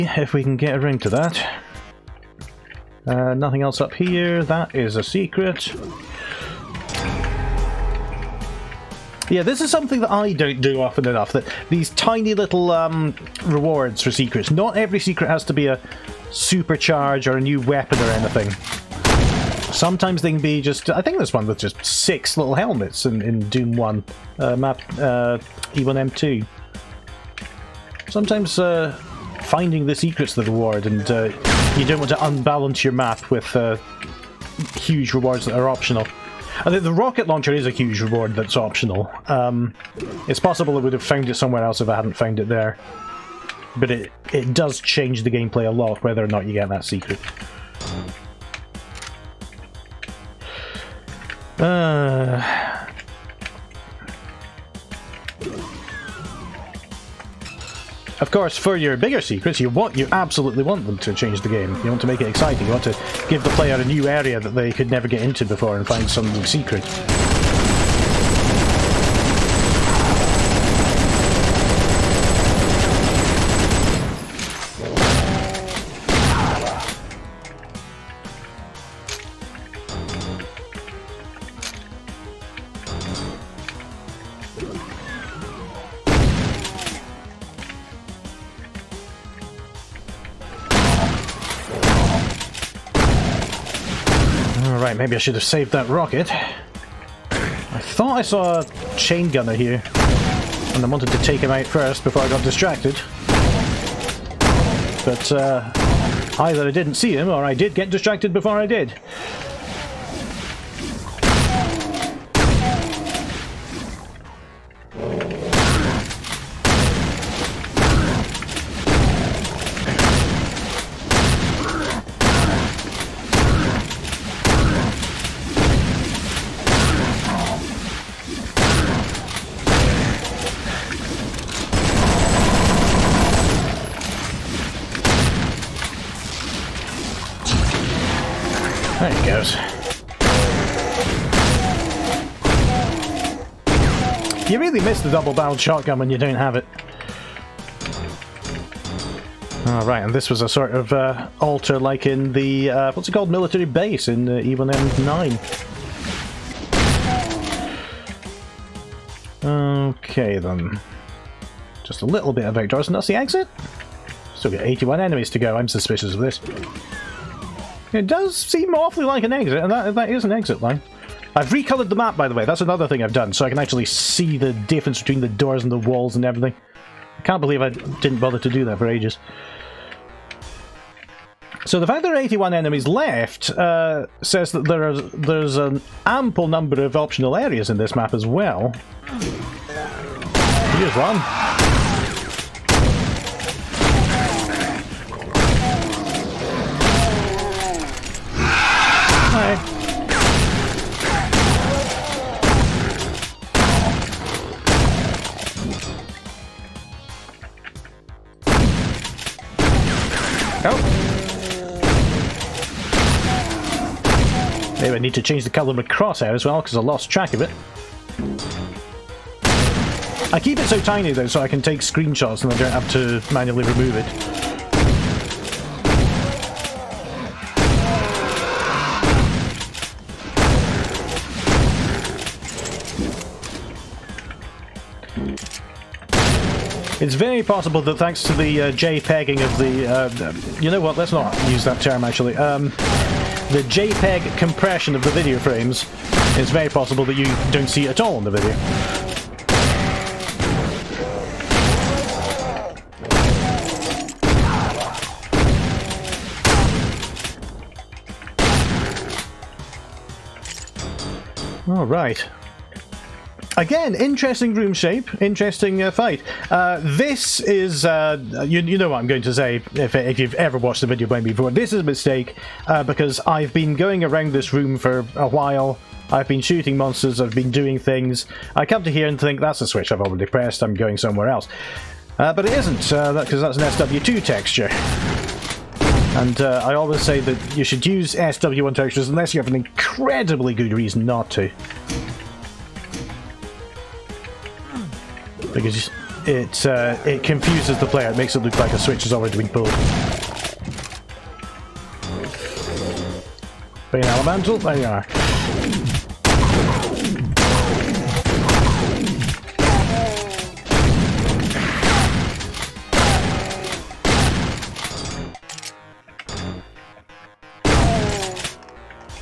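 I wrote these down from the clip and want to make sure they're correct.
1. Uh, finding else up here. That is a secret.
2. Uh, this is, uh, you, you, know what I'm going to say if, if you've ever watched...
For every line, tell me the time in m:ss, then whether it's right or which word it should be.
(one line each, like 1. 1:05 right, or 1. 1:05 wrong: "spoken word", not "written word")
1. 0:03 wrong: "nothing", not "finding"
2. 4:26 right.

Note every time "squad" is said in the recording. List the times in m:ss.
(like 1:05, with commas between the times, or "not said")
not said.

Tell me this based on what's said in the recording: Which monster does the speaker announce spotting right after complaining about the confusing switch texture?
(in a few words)
Pain Elemental.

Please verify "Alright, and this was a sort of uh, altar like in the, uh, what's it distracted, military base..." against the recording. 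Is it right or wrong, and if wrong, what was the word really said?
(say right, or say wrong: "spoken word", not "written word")
wrong: "called", not "distracted".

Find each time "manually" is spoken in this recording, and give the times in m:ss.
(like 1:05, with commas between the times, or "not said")
3:43.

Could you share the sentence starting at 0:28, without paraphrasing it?
Sometimes uh, finding the secret's the reward and...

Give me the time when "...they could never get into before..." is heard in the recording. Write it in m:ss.
1:04.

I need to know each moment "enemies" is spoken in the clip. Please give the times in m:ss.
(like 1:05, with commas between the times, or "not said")
2:45, 3:02.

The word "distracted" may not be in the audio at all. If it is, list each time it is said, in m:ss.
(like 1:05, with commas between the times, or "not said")
1:42, 1:47.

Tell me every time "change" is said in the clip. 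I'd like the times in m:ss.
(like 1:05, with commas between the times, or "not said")
0:44, 1:01, 3:35.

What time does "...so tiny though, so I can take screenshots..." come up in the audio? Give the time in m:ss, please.
3:40.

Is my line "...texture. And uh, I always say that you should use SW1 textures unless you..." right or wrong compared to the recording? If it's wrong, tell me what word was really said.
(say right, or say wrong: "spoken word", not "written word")
right.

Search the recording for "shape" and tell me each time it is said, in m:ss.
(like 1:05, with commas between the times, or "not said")
4:24.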